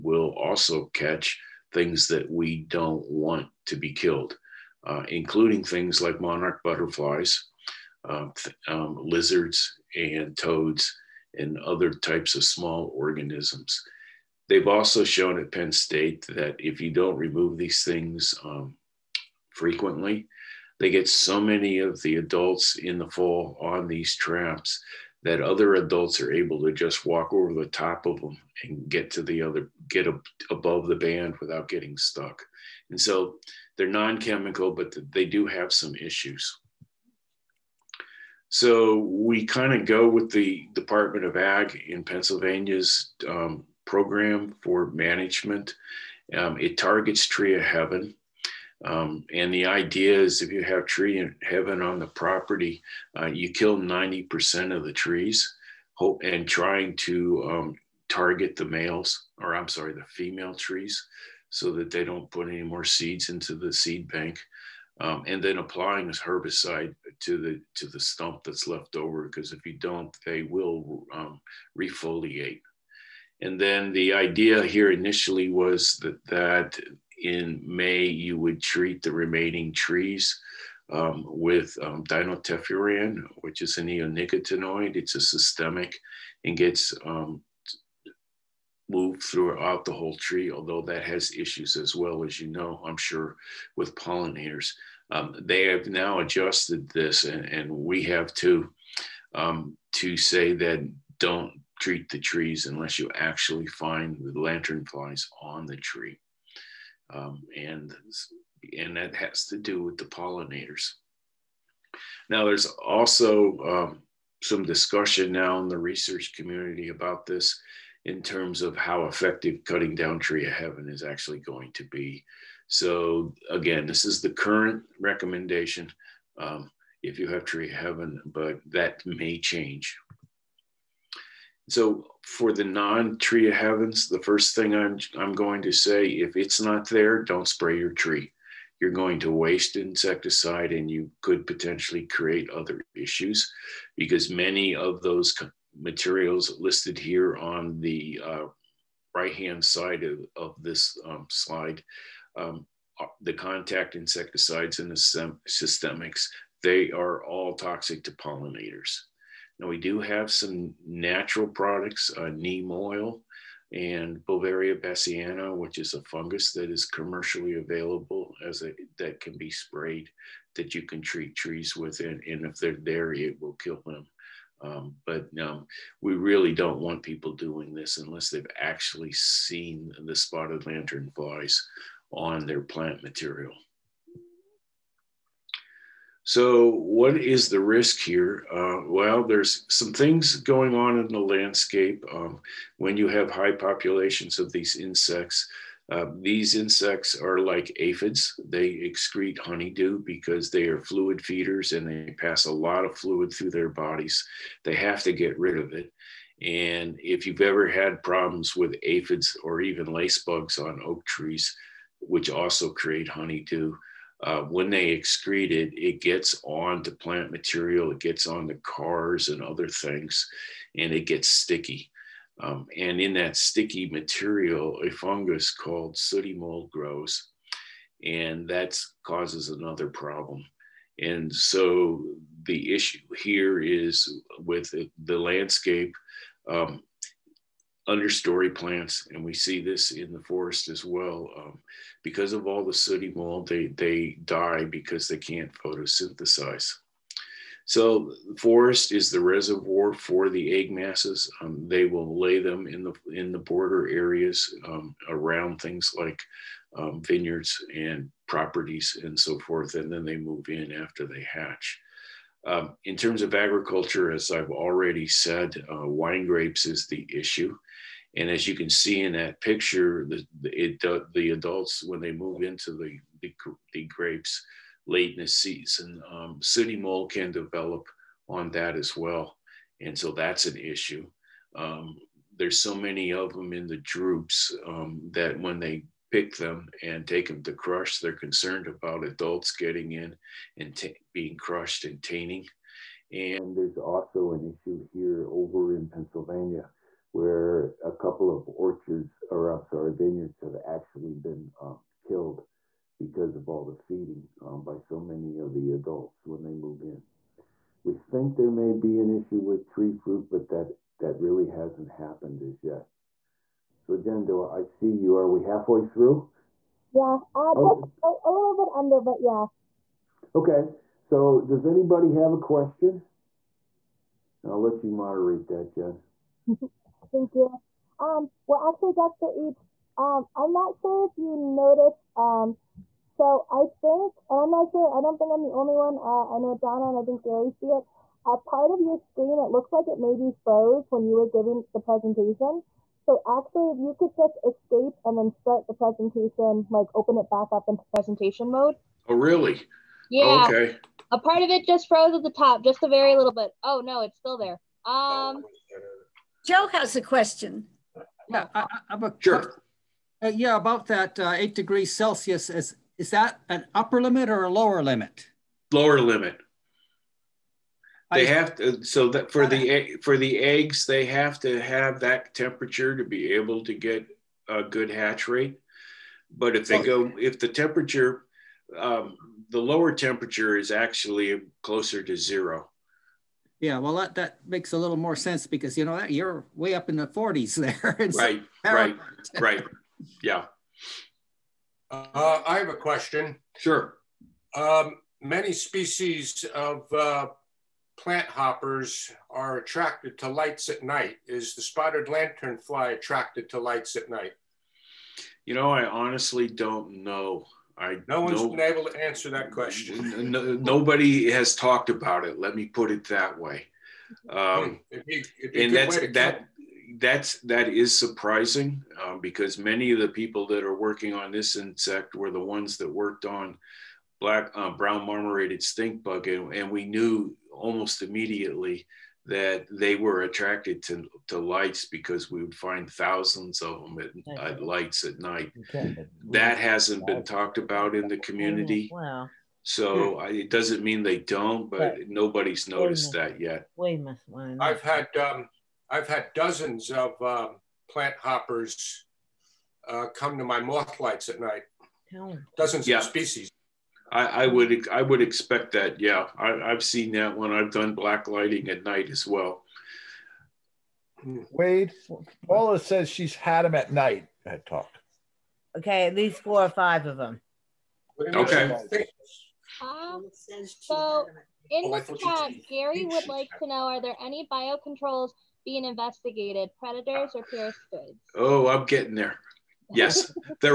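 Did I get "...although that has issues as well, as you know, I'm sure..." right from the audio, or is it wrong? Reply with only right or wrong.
right.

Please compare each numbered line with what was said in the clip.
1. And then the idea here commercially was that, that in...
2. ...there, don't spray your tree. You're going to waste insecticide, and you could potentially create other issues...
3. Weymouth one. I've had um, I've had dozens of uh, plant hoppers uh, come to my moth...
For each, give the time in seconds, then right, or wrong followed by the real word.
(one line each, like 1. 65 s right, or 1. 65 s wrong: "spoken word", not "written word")
1. 73 s wrong: "initially", not "commercially"
2. 136 s right
3. 443 s right.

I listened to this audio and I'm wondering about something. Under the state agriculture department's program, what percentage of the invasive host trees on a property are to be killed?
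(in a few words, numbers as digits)
90%.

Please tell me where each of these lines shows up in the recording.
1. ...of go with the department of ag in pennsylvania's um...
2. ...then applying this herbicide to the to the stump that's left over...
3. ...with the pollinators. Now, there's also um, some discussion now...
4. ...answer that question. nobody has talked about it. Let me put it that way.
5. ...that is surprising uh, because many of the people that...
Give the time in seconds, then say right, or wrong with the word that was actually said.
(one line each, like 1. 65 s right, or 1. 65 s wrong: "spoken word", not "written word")
1. 39 s right
2. 65 s right
3. 109 s right
4. 409 s right
5. 417 s right.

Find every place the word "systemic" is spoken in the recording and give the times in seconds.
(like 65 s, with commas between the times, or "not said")
85 s, 155 s.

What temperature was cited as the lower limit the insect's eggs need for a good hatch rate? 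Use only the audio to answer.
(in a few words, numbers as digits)
8 degrees Celsius.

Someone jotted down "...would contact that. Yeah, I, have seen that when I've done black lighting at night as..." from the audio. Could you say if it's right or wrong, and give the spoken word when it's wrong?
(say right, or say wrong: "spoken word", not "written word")
wrong: "expect", not "contact".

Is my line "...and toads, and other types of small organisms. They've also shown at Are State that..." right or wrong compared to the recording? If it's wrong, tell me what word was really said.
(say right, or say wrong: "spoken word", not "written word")
wrong: "Penn", not "Are".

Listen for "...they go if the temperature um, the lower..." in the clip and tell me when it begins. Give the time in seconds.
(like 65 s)
376 s.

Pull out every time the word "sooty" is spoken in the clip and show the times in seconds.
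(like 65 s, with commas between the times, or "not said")
225 s, 242 s, 276 s.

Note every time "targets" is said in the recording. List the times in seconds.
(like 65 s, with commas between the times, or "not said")
46 s, 58 s.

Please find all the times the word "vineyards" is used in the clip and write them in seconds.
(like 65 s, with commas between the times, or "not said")
257 s, 299 s.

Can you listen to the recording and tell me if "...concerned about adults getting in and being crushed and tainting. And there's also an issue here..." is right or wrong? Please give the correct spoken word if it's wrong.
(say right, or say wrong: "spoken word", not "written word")
right.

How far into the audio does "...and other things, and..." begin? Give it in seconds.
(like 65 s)
219 s.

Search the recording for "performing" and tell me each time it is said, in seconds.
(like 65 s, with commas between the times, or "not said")
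not said.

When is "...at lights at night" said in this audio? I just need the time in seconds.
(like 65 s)
434 s.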